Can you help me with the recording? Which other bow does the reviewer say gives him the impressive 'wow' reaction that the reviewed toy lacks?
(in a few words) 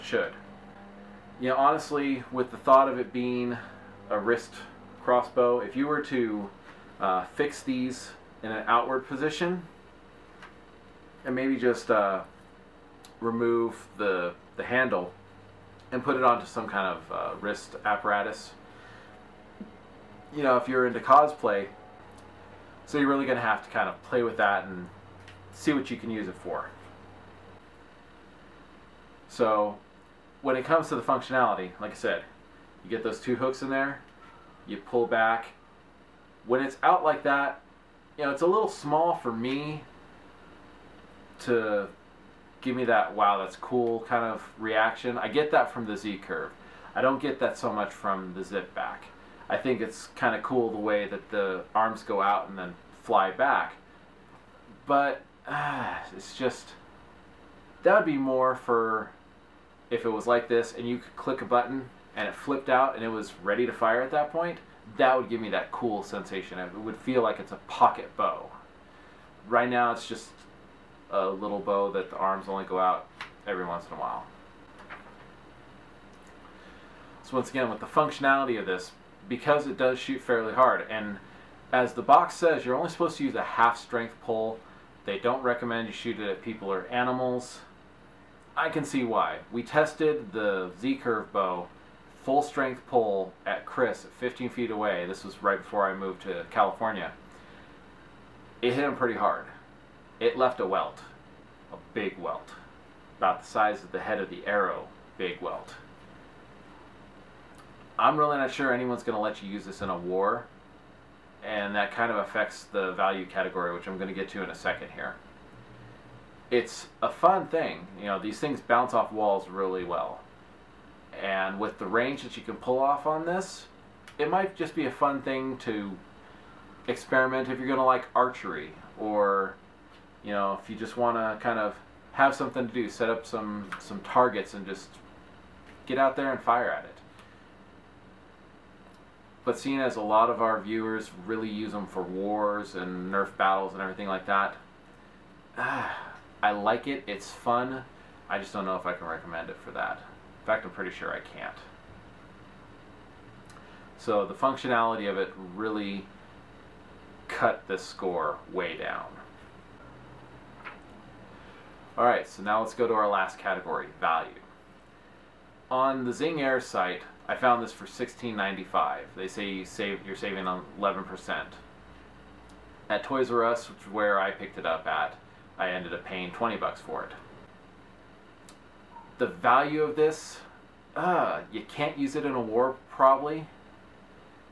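Z-curve.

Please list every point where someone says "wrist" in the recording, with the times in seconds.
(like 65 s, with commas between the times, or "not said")
4 s, 17 s.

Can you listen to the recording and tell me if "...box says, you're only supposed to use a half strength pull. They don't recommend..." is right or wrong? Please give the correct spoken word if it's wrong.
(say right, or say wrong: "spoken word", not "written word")
right.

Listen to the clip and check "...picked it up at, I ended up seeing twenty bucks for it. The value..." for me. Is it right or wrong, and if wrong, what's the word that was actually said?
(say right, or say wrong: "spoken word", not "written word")
wrong: "paying", not "seeing".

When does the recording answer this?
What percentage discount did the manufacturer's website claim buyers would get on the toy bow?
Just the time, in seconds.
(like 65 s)
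170 s.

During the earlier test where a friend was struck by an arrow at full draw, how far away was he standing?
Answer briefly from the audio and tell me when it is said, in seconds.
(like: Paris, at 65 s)
15 feet, at 94 s.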